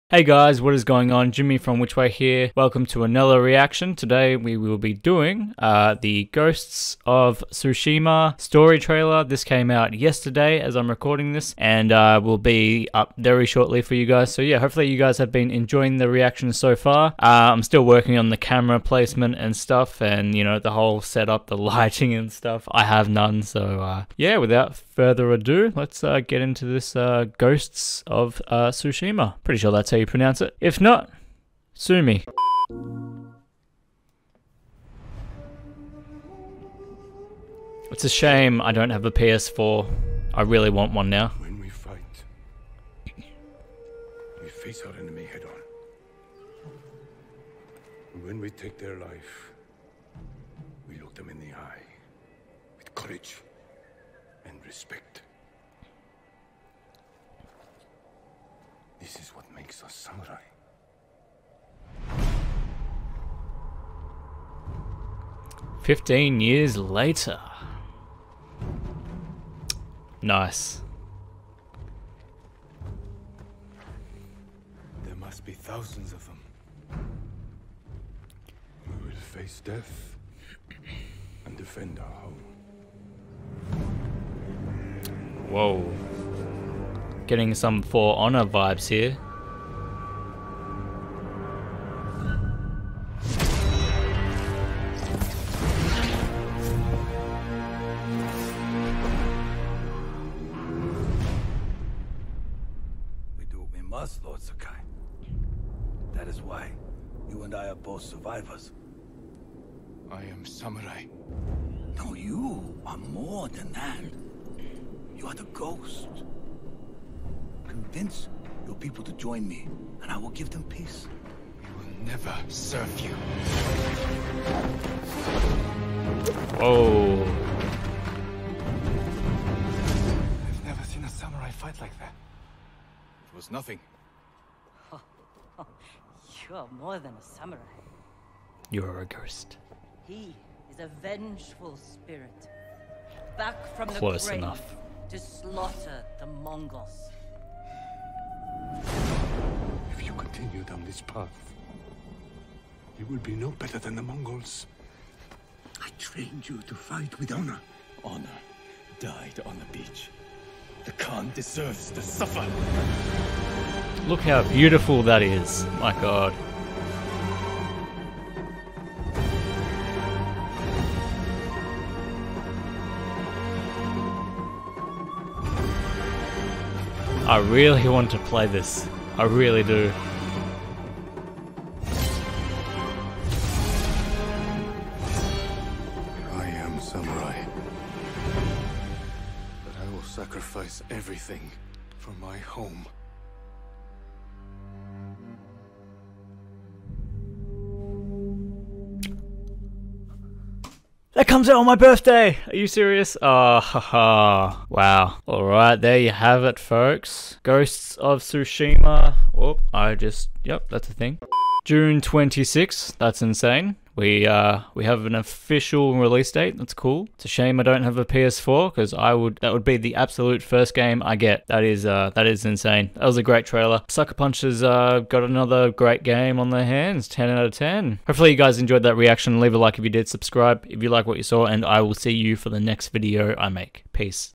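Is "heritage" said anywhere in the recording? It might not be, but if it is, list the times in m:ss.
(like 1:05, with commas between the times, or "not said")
not said.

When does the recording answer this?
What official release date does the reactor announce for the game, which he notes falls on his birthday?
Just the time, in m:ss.
3:31.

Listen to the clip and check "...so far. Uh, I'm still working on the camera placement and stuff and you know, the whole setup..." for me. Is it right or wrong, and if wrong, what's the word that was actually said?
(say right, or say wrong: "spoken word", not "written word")
right.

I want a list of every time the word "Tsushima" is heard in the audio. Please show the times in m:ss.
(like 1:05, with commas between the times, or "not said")
0:07, 0:28, 3:28.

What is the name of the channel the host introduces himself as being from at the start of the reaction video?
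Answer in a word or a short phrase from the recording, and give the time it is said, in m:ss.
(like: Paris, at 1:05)
WhichWay, at 0:01.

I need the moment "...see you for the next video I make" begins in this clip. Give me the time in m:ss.
3:51.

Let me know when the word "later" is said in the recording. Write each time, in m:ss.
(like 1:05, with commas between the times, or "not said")
1:06.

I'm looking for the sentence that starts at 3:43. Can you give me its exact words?
Sucker Punch has uh, got another great game on their hands.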